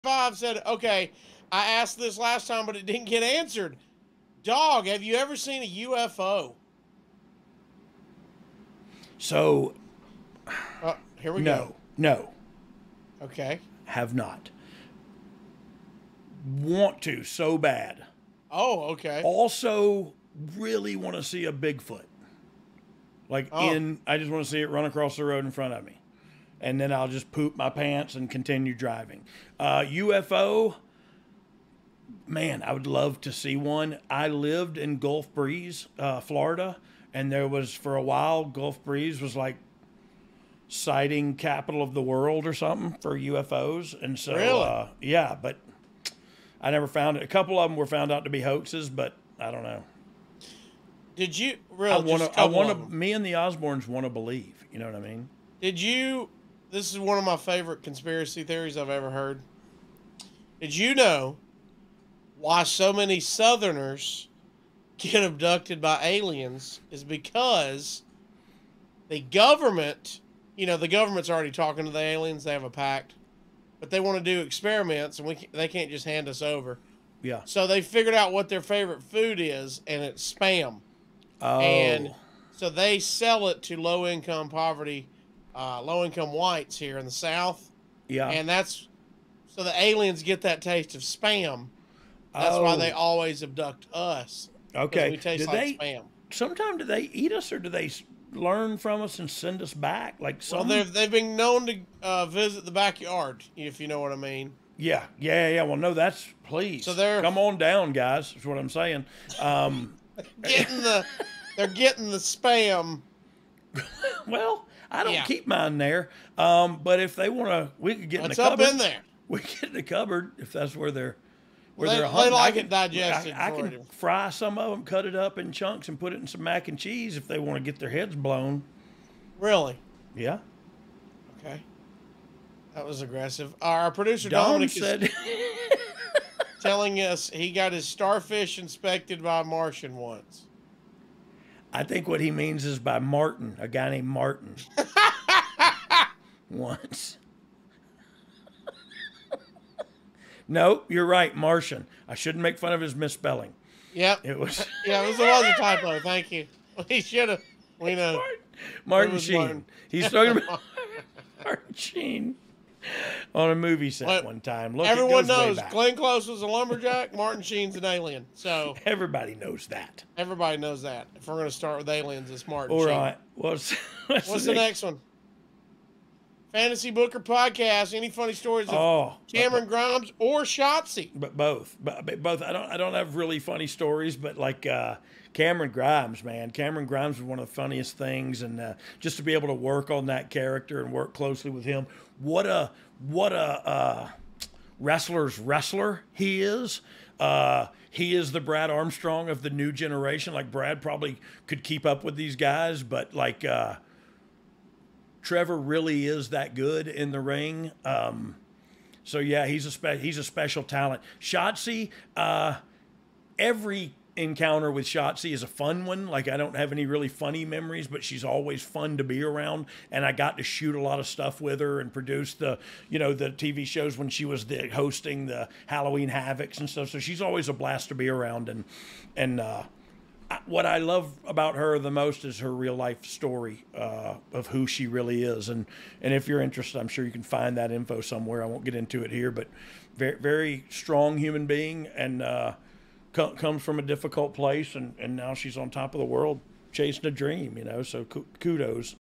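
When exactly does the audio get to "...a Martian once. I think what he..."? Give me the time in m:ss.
2:19.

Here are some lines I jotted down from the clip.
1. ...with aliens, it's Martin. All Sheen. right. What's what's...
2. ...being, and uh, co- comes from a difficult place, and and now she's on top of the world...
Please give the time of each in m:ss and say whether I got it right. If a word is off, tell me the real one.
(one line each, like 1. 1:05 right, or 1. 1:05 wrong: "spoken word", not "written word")
1. 2:51 right
2. 4:01 right.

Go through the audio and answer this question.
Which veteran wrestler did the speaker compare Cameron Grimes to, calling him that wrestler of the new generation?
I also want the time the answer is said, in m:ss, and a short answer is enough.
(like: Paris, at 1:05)
Brad Armstrong, at 3:18.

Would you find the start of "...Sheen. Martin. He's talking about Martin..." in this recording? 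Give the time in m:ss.
2:39.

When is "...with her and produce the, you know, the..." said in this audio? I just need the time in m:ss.
3:41.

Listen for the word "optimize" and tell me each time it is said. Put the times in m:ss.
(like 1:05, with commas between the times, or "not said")
not said.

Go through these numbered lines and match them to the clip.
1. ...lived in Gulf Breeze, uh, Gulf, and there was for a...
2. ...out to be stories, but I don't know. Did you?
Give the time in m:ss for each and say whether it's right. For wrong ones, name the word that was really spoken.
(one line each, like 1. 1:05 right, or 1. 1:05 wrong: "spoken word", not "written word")
1. 0:34 wrong: "Florida", not "Gulf"
2. 0:48 wrong: "hoaxes", not "stories".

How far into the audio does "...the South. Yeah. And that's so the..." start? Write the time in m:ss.
1:27.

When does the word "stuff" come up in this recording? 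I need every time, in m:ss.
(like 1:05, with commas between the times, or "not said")
3:41, 3:46.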